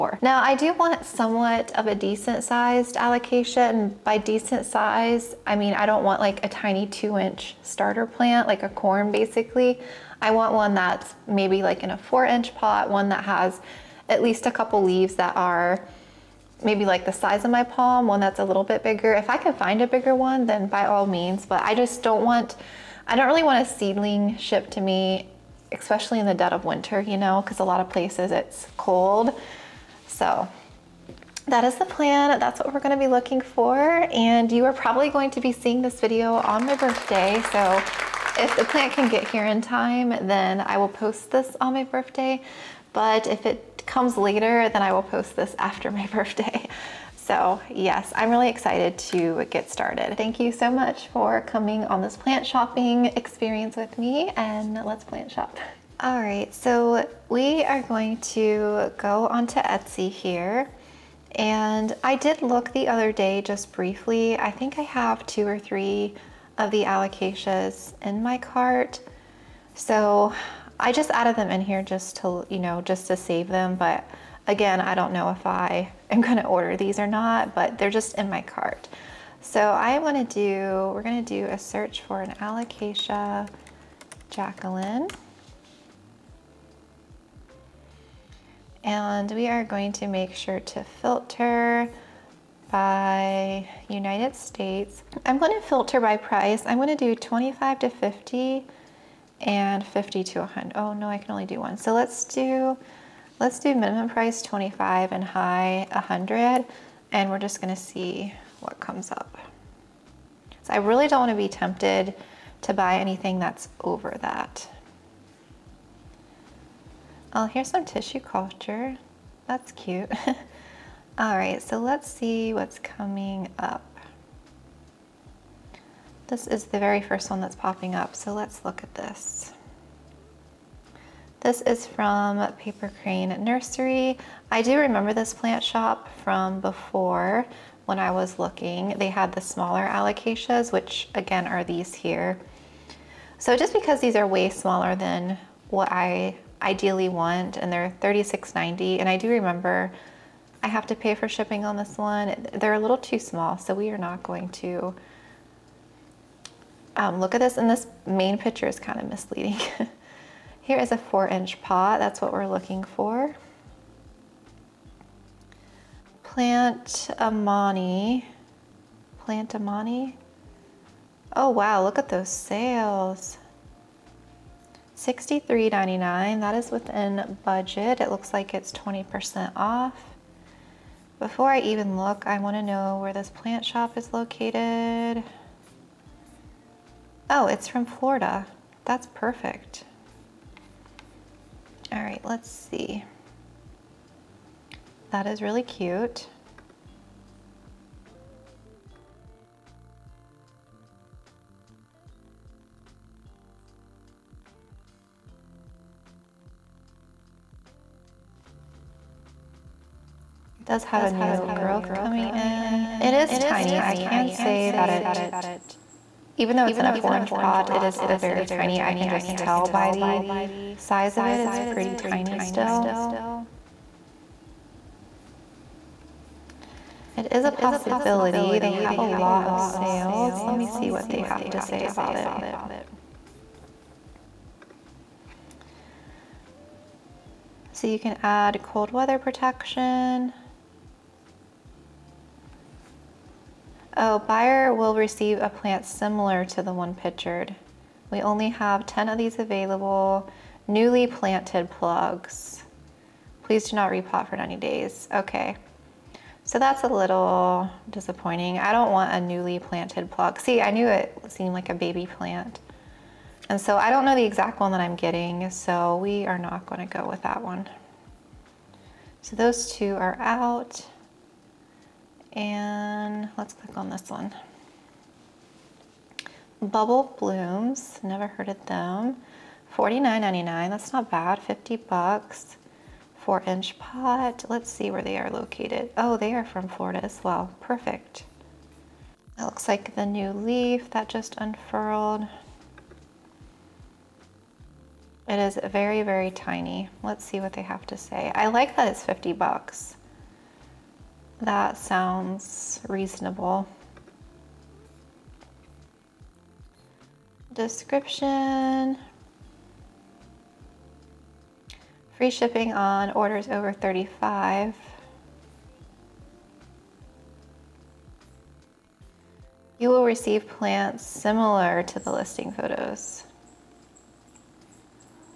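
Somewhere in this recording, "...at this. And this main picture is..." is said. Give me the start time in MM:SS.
02:37.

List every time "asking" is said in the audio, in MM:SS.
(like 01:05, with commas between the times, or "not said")
not said.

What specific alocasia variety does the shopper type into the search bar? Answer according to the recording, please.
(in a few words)
Alocasia Jacqueline.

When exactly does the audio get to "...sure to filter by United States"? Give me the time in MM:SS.
01:30.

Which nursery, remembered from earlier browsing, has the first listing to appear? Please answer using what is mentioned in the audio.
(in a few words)
Paper Crane Nursery.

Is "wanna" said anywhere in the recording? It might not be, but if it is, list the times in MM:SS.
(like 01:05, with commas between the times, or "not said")
01:19, 01:51, 03:02.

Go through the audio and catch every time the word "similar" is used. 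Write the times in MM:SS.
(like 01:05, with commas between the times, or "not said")
04:05, 05:21.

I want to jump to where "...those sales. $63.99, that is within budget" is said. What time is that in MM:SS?
02:52.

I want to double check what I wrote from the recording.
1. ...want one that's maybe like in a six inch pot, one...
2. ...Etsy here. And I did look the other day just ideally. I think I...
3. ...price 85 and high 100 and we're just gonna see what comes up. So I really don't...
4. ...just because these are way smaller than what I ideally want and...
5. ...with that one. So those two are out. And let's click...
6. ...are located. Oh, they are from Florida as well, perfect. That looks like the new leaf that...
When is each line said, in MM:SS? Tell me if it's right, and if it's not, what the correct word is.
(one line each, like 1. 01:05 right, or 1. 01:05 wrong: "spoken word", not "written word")
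1. 00:10 wrong: "four", not "six"
2. 00:59 wrong: "briefly", not "ideally"
3. 01:44 wrong: "25", not "85"
4. 02:23 right
5. 04:27 right
6. 04:45 right.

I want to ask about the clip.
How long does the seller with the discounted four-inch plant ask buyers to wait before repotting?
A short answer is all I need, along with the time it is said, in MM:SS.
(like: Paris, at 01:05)
90 days, at 04:14.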